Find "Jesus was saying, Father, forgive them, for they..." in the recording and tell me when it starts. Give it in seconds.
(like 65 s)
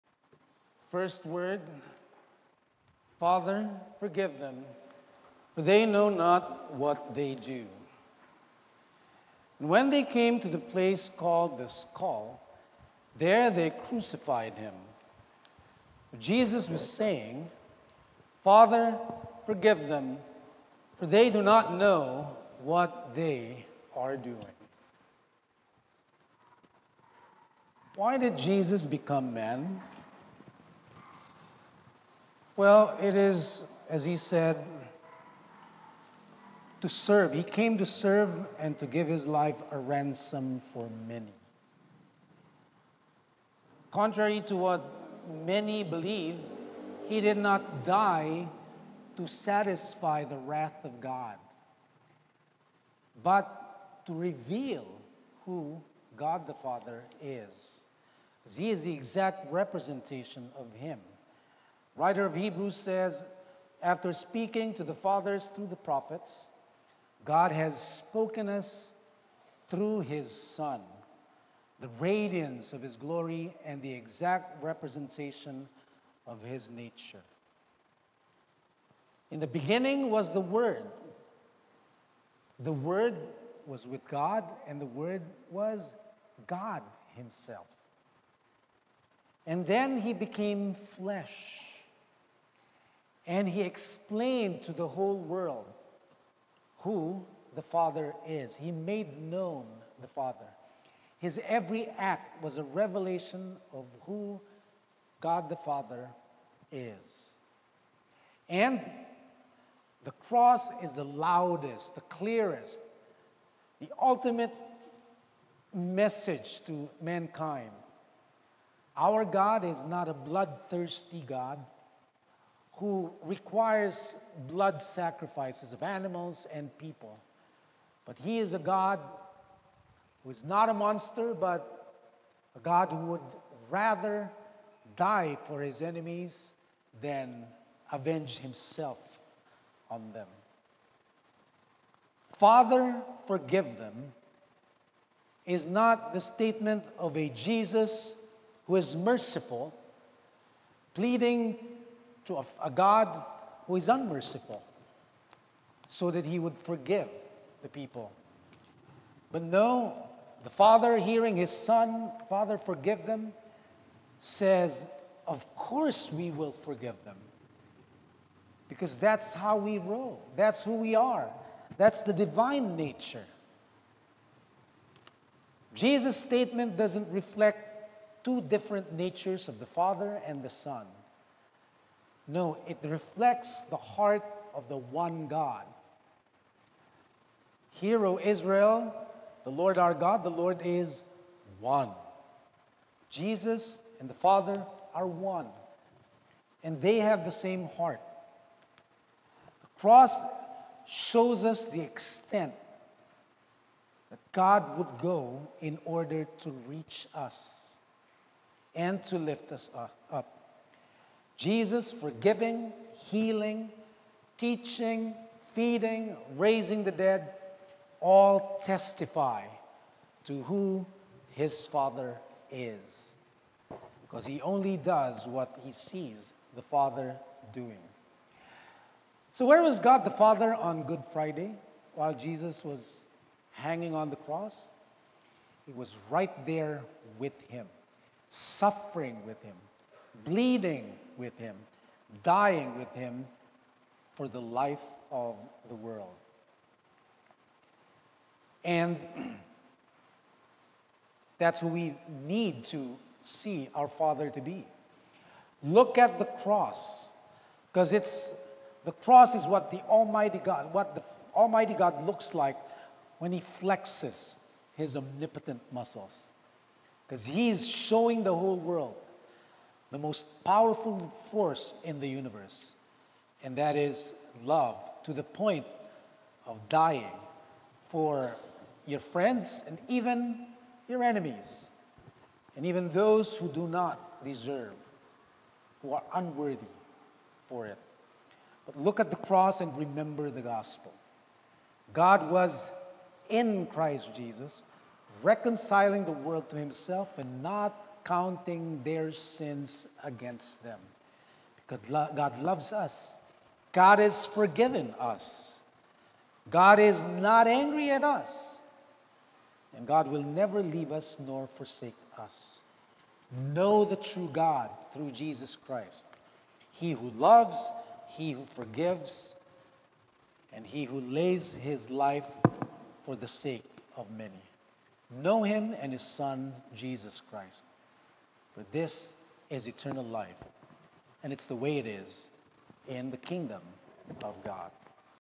16 s.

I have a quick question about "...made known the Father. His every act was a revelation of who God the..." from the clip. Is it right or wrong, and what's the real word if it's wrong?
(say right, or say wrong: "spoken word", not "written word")
right.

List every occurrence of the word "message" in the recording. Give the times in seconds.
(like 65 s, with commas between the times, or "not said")
115 s.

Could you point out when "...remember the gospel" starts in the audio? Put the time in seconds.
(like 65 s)
289 s.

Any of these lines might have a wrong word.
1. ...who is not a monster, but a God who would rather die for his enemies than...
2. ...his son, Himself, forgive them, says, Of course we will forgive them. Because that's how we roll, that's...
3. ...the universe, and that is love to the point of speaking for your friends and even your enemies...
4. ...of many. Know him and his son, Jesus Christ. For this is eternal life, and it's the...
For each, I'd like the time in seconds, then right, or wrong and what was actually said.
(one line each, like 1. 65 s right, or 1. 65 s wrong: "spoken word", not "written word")
1. 130 s right
2. 161 s wrong: "Father", not "Himself"
3. 271 s wrong: "dying", not "speaking"
4. 323 s right.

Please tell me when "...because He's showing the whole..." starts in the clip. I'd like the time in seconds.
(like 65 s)
267 s.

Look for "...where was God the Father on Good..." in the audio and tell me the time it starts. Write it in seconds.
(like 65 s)
229 s.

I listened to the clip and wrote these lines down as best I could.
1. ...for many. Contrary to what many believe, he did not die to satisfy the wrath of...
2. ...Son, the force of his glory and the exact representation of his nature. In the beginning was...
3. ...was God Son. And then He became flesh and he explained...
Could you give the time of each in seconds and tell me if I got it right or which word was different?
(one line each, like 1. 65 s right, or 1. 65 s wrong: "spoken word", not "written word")
1. 40 s right
2. 70 s wrong: "radiance", not "force"
3. 85 s wrong: "Himself", not "Son".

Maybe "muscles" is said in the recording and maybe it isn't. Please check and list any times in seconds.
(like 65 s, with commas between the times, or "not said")
265 s.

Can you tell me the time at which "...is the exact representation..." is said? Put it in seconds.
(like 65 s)
58 s.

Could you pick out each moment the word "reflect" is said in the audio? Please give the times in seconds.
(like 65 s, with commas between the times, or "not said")
177 s, 182 s.